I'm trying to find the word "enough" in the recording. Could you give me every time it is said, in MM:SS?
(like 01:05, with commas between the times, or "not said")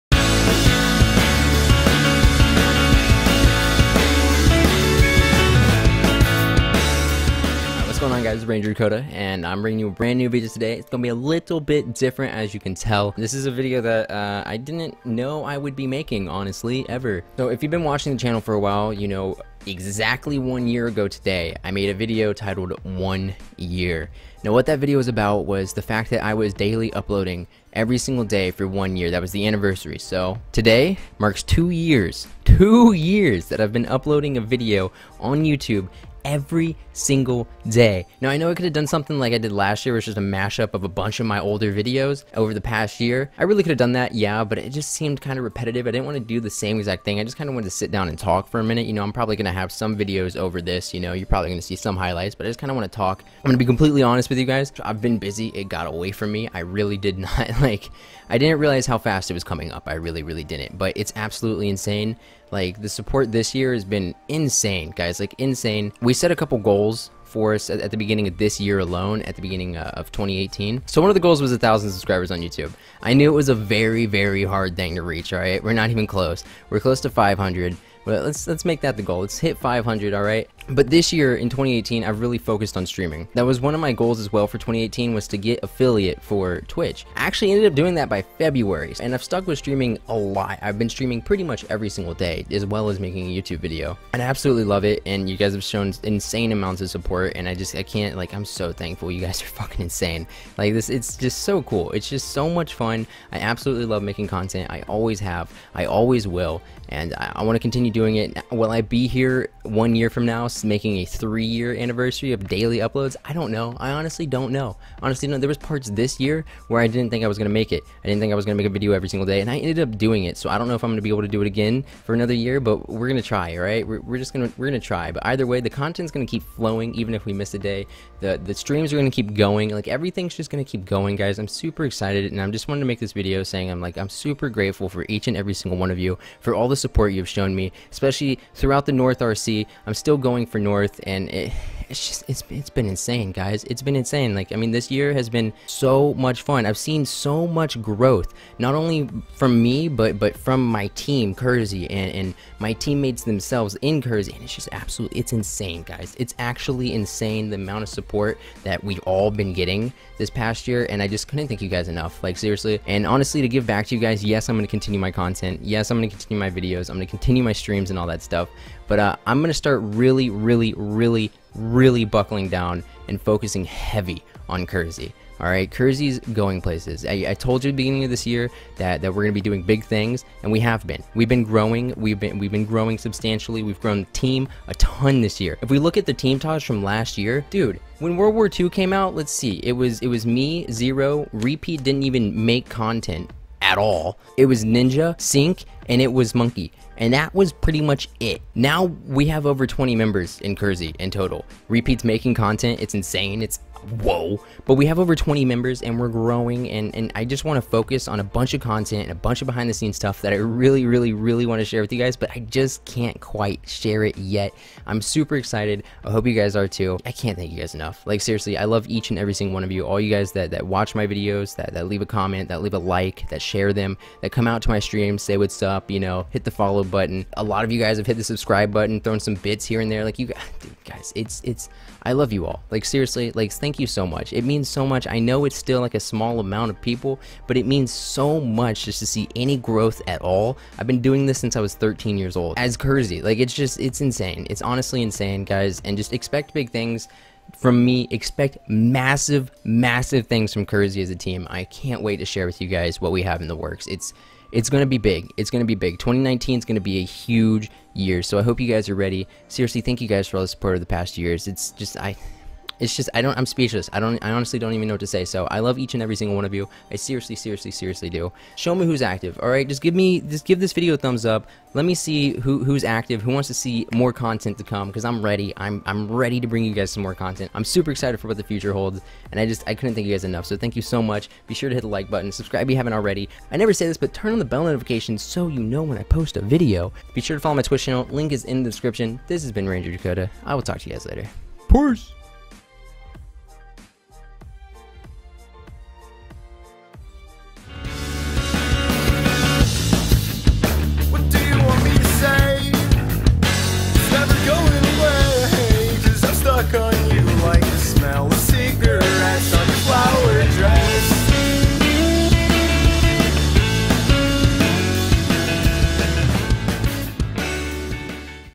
02:41, 03:37, 04:40.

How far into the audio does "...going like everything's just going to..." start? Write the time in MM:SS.
02:09.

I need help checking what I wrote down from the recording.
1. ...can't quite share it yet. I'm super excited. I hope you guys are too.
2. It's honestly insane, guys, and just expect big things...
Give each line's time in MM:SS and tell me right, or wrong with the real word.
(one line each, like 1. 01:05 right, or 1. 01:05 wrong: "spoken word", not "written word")
1. 03:32 right
2. 04:04 right.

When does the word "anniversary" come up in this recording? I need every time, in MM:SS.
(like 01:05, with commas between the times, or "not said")
00:29, 01:51.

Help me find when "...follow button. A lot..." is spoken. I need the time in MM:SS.
03:46.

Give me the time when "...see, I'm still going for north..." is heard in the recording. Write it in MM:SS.
02:19.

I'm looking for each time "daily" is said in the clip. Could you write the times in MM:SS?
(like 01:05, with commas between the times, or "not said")
00:26, 01:52.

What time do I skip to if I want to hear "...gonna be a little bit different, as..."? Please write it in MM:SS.
00:10.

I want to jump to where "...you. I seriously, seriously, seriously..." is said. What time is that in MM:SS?
04:26.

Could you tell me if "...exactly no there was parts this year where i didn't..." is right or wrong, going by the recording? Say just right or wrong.
wrong.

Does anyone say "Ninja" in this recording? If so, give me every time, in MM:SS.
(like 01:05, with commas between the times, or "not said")
03:14.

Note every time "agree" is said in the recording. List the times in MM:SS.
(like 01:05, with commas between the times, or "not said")
not said.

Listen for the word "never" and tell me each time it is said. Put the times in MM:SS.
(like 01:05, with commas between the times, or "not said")
04:43.